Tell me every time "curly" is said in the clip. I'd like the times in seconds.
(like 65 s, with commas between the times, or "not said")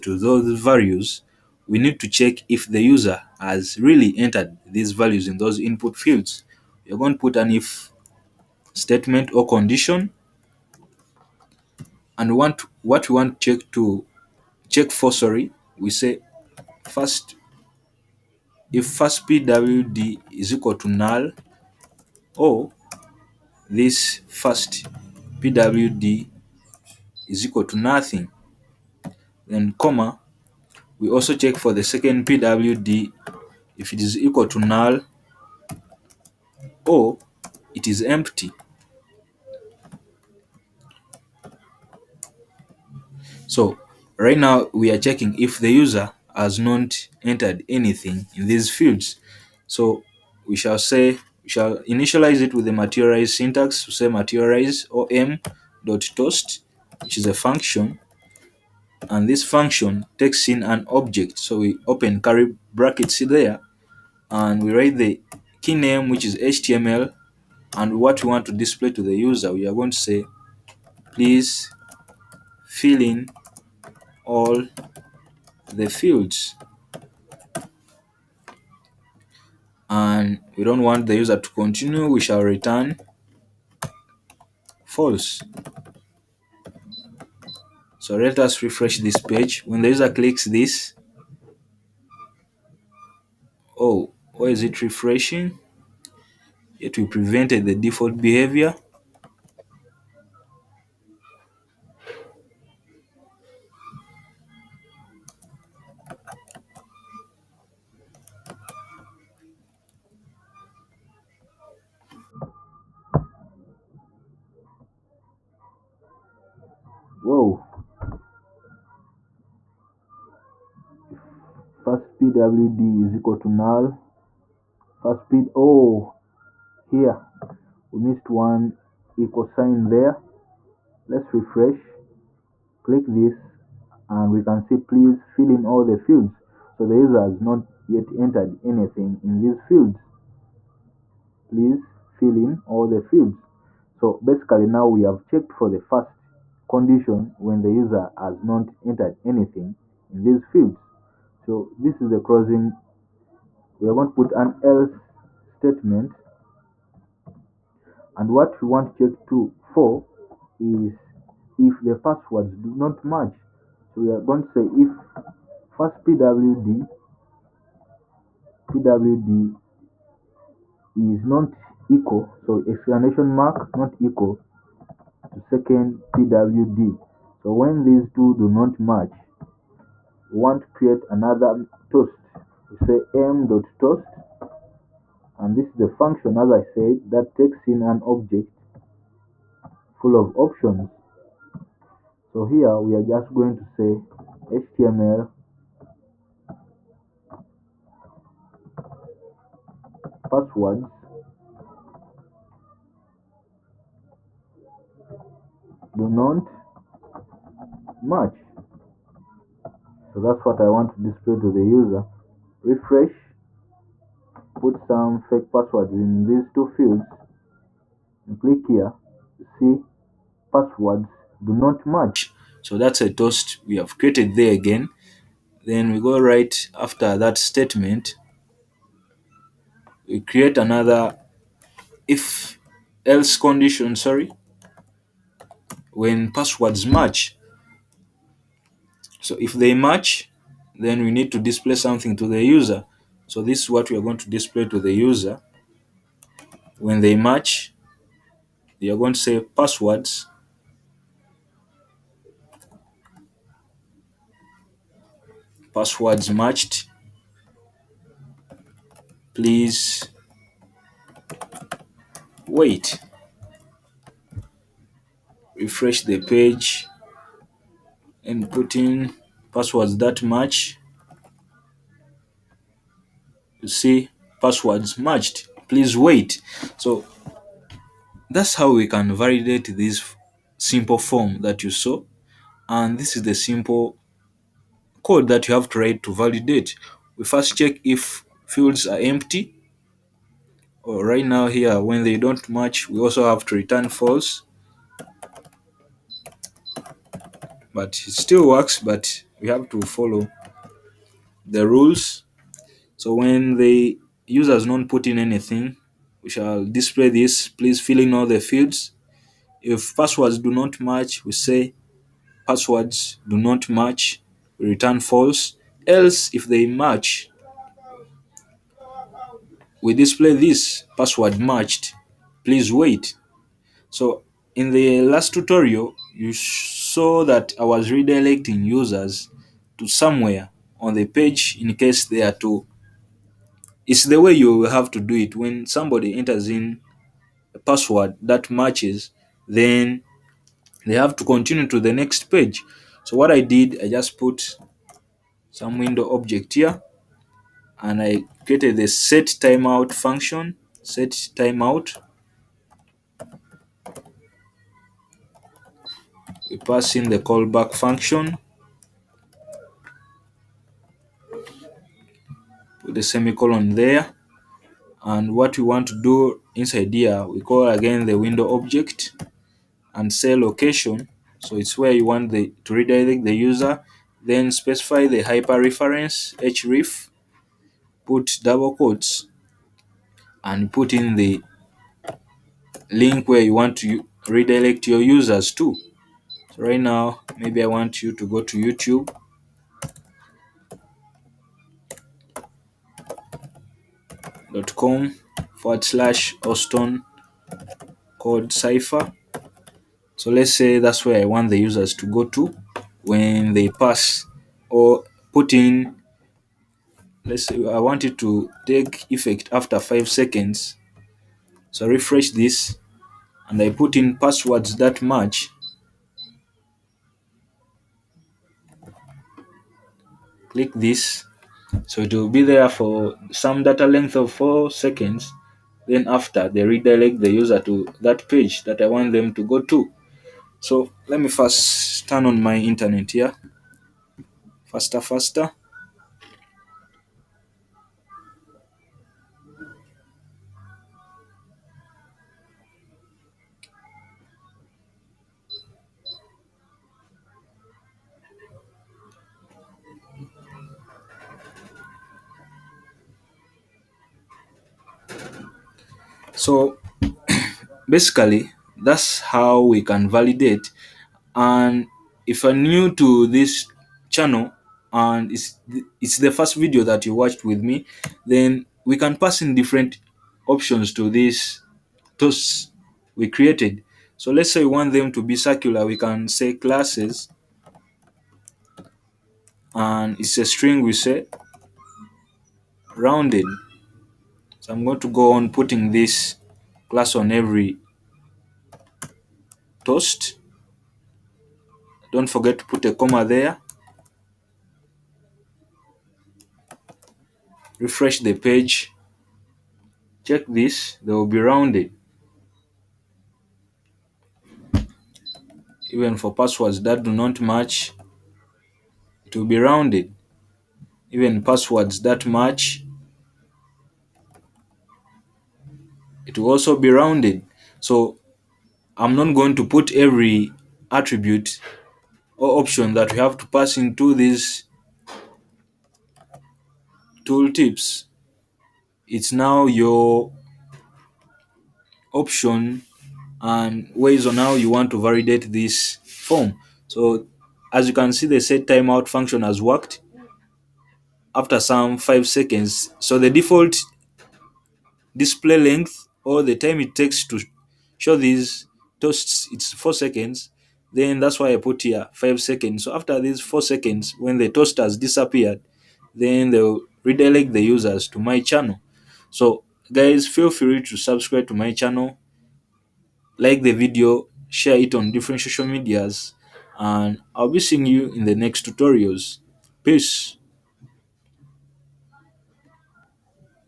62 s.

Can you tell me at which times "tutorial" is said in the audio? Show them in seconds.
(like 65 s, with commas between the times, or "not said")
325 s, 568 s.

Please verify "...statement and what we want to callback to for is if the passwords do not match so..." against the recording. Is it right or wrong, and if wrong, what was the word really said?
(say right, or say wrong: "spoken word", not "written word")
wrong: "check", not "callback".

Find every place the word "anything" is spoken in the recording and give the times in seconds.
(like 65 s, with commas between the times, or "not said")
47 s, 138 s, 149 s, 305 s.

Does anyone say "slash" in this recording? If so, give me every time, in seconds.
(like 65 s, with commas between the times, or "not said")
395 s.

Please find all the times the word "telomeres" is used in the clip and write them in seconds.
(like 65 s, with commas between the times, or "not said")
not said.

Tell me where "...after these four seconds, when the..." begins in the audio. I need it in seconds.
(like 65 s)
552 s.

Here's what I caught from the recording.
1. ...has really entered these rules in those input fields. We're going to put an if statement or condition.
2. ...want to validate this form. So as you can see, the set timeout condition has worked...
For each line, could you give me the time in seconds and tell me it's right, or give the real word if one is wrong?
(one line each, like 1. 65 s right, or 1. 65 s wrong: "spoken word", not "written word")
1. 3 s wrong: "values", not "rules"
2. 534 s wrong: "function", not "condition".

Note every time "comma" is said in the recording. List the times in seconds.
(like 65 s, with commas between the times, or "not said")
29 s, 492 s.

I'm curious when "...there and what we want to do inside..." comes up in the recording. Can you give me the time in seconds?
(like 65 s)
363 s.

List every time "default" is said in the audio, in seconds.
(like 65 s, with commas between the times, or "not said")
97 s, 543 s.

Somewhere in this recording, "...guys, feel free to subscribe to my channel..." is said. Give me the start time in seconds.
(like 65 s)
559 s.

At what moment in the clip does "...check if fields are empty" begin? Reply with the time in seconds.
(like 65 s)
287 s.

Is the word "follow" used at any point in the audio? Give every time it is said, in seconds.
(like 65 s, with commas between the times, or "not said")
299 s.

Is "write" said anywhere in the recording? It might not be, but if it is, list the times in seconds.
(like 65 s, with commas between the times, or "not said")
64 s, 285 s.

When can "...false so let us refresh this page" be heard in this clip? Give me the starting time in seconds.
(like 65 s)
84 s.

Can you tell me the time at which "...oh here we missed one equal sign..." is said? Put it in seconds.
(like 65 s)
125 s.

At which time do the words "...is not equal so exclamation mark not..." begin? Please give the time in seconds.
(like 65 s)
170 s.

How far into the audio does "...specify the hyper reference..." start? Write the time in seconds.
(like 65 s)
374 s.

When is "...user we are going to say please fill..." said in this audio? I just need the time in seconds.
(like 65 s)
69 s.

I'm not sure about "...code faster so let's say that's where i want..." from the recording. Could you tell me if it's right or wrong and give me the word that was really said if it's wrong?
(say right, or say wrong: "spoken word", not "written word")
wrong: "cypher", not "faster".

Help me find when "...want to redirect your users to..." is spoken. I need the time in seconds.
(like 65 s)
383 s.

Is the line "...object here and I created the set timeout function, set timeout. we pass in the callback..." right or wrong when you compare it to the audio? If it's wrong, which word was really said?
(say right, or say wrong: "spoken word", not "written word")
right.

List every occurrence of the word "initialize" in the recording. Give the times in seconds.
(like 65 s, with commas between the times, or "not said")
51 s.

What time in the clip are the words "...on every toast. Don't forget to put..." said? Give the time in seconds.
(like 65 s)
487 s.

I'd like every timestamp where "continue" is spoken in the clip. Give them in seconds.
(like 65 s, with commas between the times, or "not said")
81 s, 341 s.